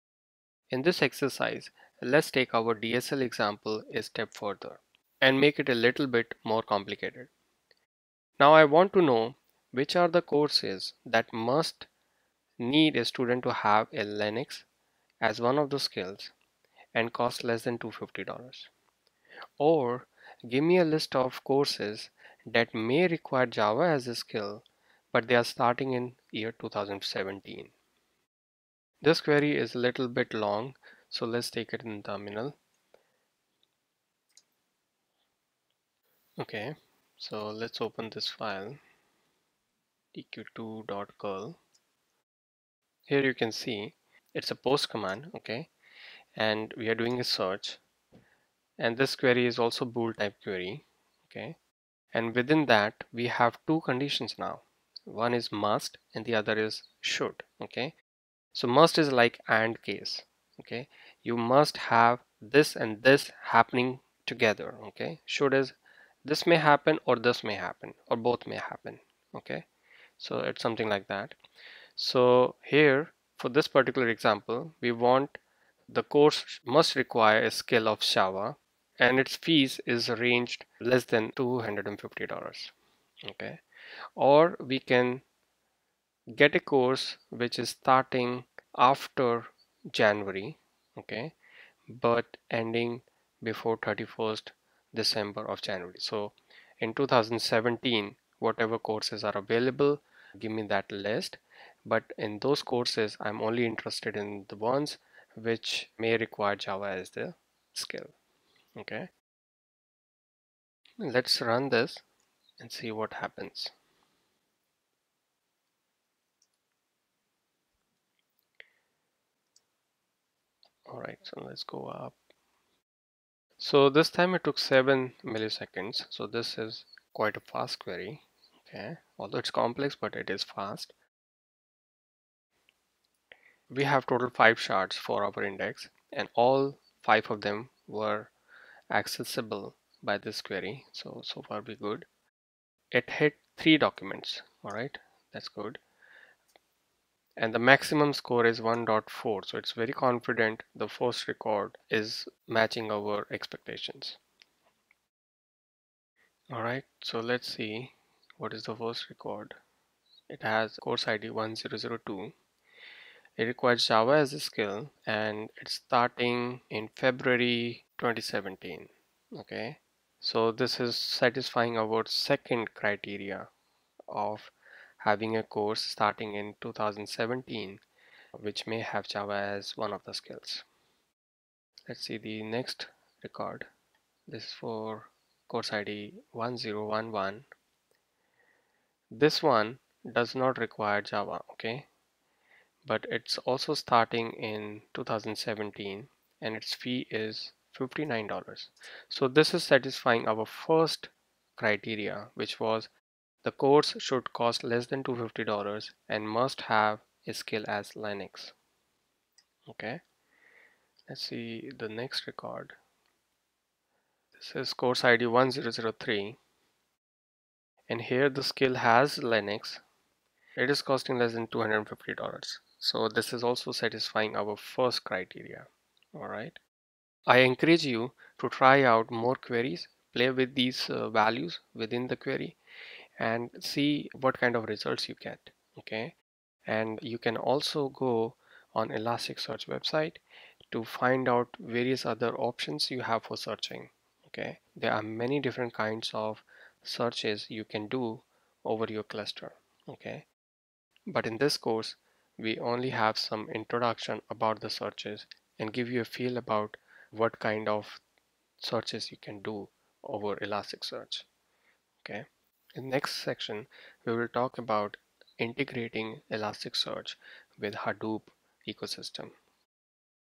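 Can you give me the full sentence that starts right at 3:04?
This is for course ID 1011.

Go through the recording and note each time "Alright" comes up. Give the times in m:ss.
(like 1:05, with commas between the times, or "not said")
3:46.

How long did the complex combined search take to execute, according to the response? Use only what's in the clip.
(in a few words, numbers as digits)
7 milliseconds.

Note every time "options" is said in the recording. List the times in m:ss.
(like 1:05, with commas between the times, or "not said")
4:02.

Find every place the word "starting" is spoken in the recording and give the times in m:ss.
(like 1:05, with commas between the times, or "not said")
0:25, 1:27, 2:45, 2:55, 3:13.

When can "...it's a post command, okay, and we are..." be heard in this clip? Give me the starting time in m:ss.
0:44.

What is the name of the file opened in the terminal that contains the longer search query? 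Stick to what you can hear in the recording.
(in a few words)
eq2.curl.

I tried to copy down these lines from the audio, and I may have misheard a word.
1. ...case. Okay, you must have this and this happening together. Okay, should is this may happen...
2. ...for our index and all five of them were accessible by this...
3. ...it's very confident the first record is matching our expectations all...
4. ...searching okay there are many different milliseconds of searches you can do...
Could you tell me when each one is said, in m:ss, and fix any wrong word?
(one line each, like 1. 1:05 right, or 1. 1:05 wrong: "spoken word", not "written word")
1. 0:59 right
2. 2:15 right
3. 2:29 right
4. 4:03 wrong: "kinds", not "milliseconds".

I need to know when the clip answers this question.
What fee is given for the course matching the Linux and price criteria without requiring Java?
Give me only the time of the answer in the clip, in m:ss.
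3:17.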